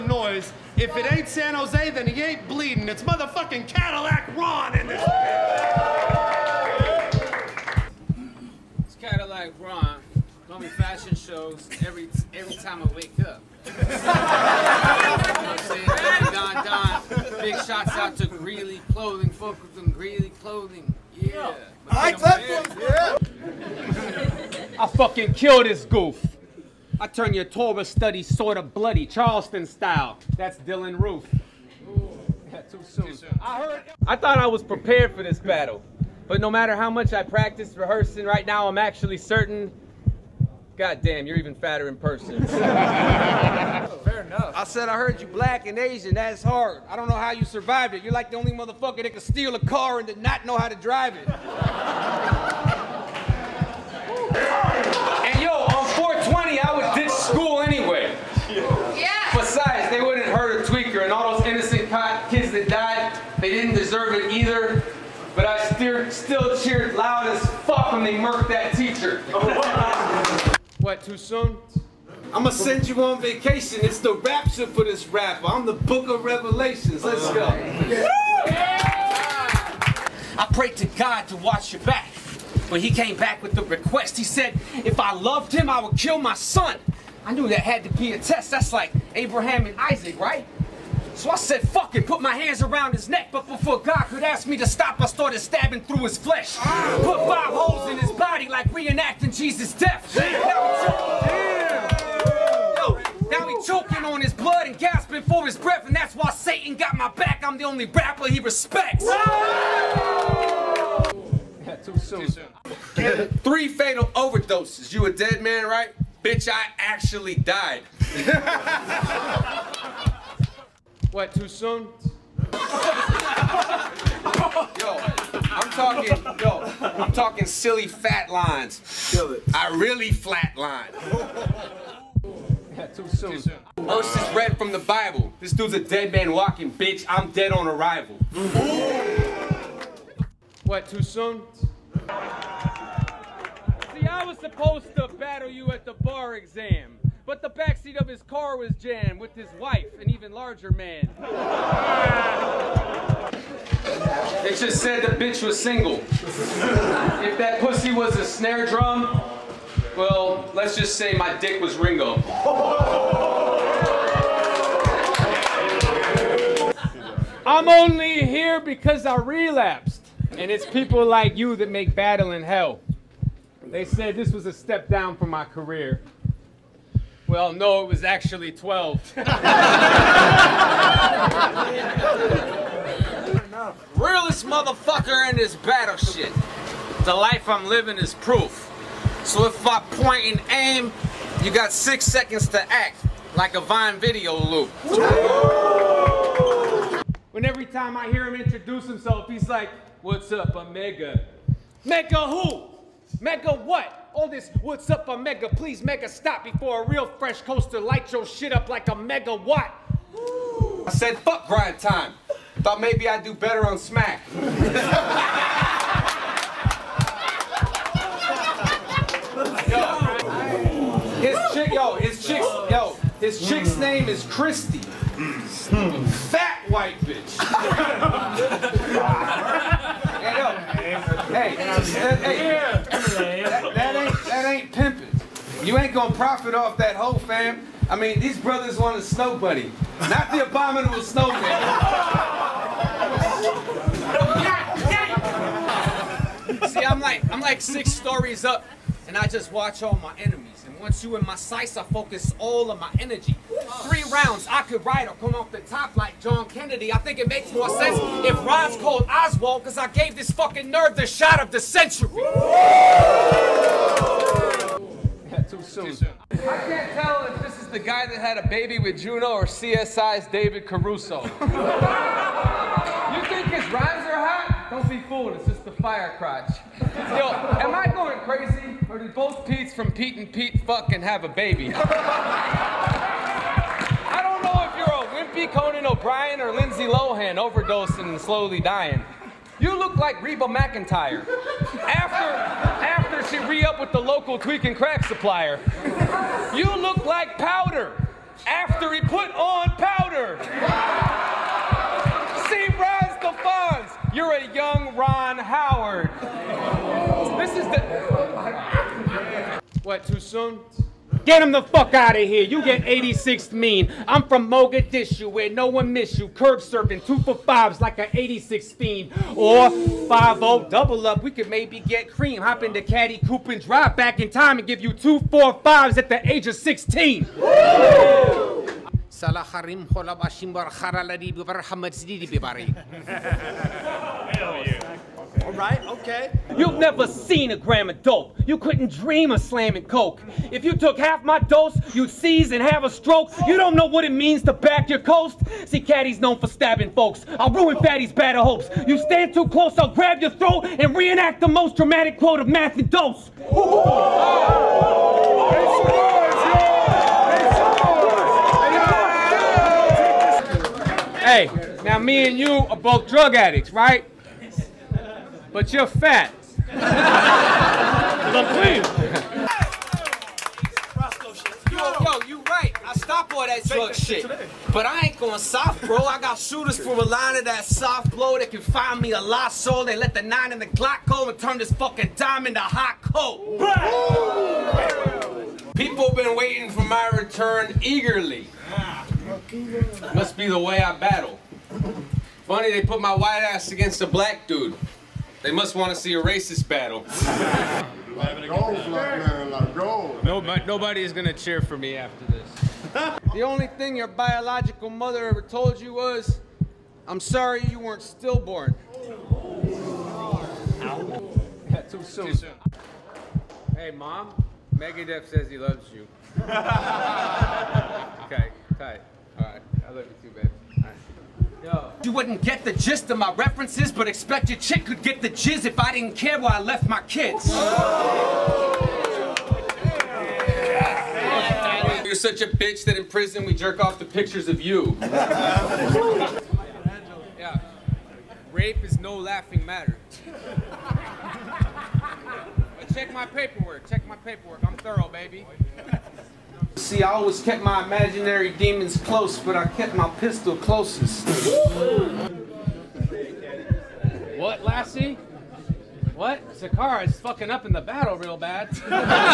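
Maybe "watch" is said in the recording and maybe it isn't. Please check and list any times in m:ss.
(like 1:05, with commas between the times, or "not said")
1:21, 4:09.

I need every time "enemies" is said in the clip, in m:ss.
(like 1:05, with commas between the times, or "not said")
4:10.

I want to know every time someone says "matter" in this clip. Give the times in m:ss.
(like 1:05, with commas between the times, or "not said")
0:36, 7:19.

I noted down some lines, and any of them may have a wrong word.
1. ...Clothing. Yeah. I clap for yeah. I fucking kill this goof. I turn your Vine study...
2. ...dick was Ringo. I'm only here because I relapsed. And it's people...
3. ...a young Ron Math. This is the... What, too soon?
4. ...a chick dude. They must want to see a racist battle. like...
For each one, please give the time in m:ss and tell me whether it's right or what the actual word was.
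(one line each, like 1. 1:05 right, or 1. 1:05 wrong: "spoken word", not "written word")
1. 0:20 wrong: "Torah", not "Vine"
2. 2:41 right
3. 5:04 wrong: "Howard", not "Math"
4. 6:34 wrong: "black", not "chick".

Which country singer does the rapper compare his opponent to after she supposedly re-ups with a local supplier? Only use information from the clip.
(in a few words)
Reba McEntire.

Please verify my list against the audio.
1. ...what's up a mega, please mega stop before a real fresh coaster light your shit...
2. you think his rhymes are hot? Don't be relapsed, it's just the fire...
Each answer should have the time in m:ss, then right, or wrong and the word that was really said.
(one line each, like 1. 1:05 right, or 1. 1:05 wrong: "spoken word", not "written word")
1. 3:24 right
2. 4:31 wrong: "fooled", not "relapsed".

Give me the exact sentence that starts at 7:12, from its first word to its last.
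You're such a bitch that in prison we jerk off the pictures of you.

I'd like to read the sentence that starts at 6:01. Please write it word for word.
Hey, now me and you are both drug addicts, right?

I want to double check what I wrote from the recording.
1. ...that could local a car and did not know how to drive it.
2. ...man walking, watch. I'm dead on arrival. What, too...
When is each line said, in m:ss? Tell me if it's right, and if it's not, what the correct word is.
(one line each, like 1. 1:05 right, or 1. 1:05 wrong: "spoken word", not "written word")
1. 0:49 wrong: "steal", not "local"
2. 2:16 wrong: "bitch", not "watch".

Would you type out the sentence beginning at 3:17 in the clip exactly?
When every time I hear him introduce himself, he's like, what's up, Omega?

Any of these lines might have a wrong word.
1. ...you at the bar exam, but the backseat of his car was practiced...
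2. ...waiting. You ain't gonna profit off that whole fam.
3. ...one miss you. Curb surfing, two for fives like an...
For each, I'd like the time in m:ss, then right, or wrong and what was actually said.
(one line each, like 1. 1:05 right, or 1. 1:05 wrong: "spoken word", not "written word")
1. 2:25 wrong: "jammed", not "practiced"
2. 3:54 wrong: "pimping", not "waiting"
3. 5:15 right.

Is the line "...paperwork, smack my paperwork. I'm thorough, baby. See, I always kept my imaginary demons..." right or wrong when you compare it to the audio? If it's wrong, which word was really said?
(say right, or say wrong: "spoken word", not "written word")
wrong: "check", not "smack".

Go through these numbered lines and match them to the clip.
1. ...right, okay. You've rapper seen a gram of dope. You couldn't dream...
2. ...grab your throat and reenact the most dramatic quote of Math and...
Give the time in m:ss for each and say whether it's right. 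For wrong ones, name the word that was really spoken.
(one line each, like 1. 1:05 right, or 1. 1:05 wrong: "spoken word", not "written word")
1. 5:35 wrong: "never", not "rapper"
2. 5:49 right.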